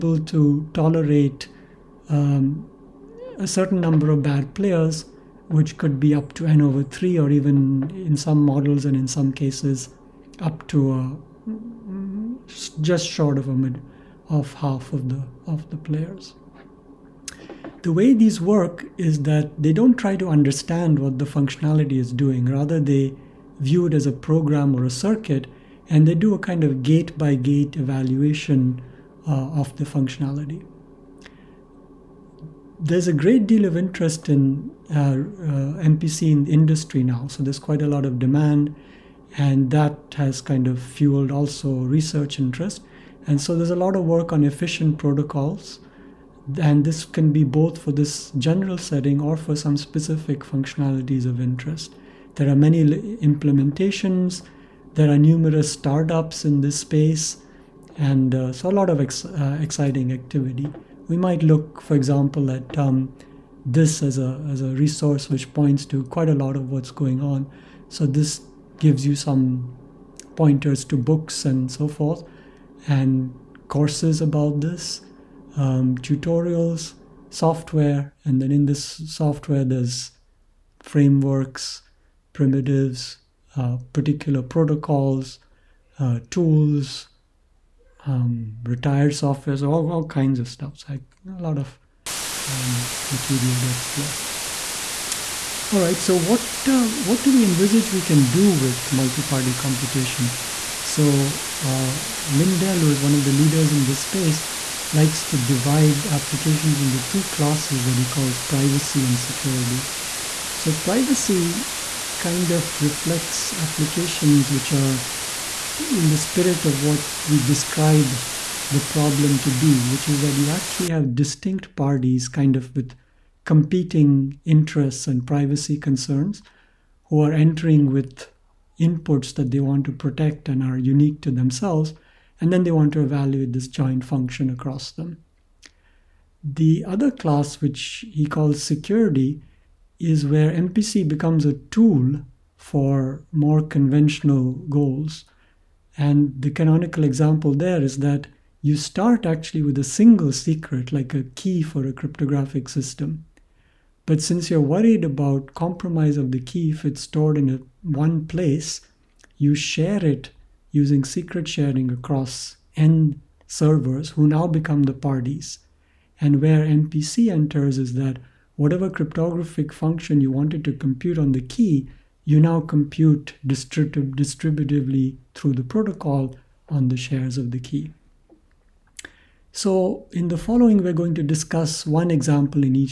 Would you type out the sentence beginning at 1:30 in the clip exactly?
So I, a lot of um, material to explore.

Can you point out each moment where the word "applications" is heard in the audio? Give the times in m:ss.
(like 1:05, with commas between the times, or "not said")
1:46, 1:53.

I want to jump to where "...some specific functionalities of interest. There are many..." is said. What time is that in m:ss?
0:49.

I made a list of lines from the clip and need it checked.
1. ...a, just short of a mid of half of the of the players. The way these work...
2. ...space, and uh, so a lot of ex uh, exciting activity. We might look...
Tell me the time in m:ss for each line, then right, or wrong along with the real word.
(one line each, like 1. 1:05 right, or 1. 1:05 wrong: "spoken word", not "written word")
1. 0:10 right
2. 0:56 right.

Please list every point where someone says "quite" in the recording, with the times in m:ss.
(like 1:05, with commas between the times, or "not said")
0:37, 1:06.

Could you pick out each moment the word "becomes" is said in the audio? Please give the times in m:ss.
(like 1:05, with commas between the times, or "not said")
2:21, 2:44.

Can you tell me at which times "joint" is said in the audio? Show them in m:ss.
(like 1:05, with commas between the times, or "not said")
2:13.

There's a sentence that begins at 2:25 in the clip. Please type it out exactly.
And the canonical example there is that you start actually with a single secret, like a key for a cryptographic system.